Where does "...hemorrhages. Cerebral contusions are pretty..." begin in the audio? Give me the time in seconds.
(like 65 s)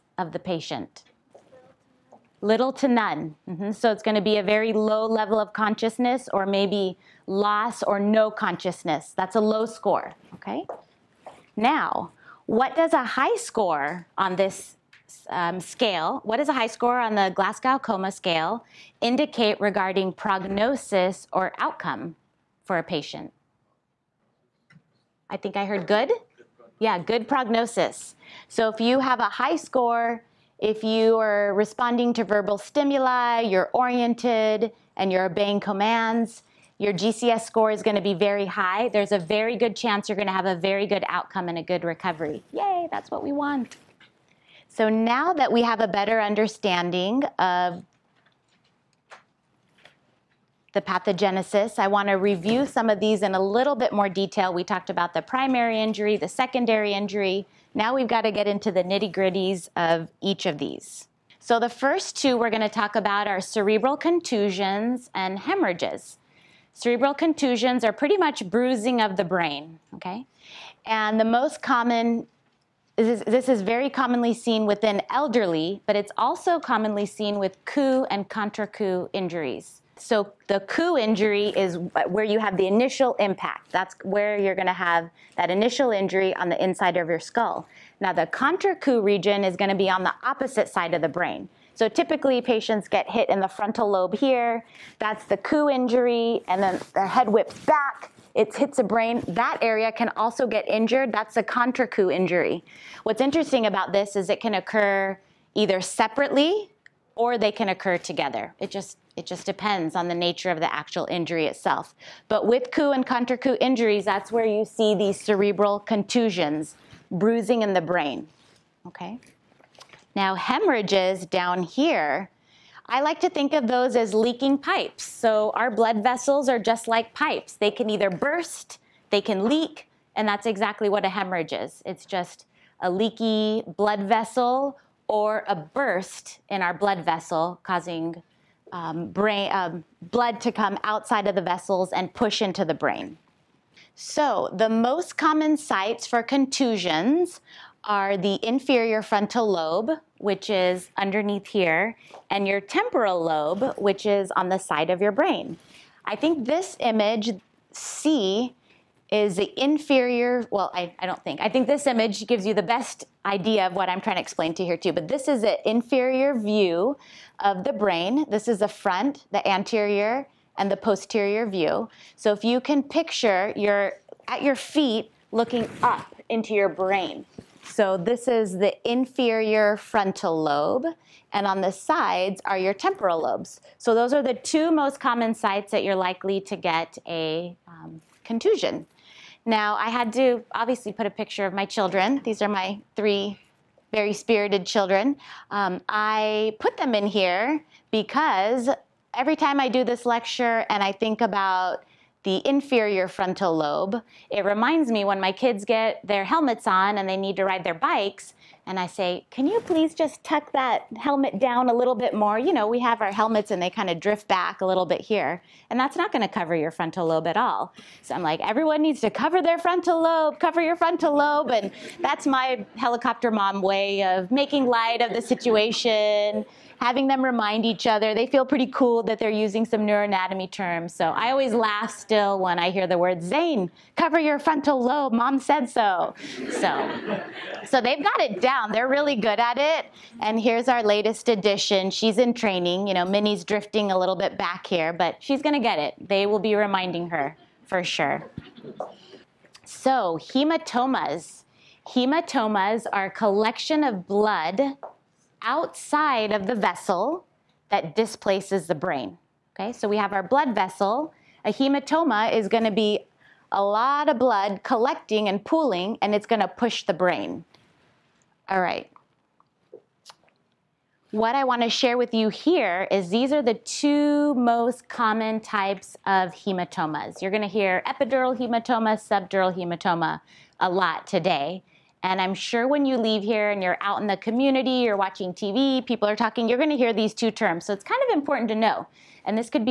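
65 s.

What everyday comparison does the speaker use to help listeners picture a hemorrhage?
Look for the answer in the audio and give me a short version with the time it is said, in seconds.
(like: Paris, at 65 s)
leaking pipes, at 124 s.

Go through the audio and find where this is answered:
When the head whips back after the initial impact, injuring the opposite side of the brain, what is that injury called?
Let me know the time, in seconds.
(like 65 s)
101 s.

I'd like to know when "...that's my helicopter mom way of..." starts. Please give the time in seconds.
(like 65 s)
222 s.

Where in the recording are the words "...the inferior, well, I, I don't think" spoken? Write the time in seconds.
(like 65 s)
159 s.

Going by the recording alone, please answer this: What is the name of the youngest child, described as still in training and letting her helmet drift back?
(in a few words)
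Minnie.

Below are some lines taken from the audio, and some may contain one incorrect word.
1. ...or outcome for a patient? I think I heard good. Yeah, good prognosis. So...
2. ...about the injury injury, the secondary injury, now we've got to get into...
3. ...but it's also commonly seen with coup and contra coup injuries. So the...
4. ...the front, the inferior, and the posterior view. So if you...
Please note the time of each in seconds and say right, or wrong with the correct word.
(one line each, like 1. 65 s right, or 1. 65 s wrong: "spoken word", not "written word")
1. 21 s right
2. 54 s wrong: "primary", not "injury"
3. 75 s right
4. 168 s wrong: "anterior", not "inferior".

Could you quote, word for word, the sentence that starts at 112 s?
But with coup and contra coup injuries, that's where you see these cerebral contusions, bruising in the brain.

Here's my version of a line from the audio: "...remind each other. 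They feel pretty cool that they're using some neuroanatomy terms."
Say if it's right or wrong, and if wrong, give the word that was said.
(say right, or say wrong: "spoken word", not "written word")
right.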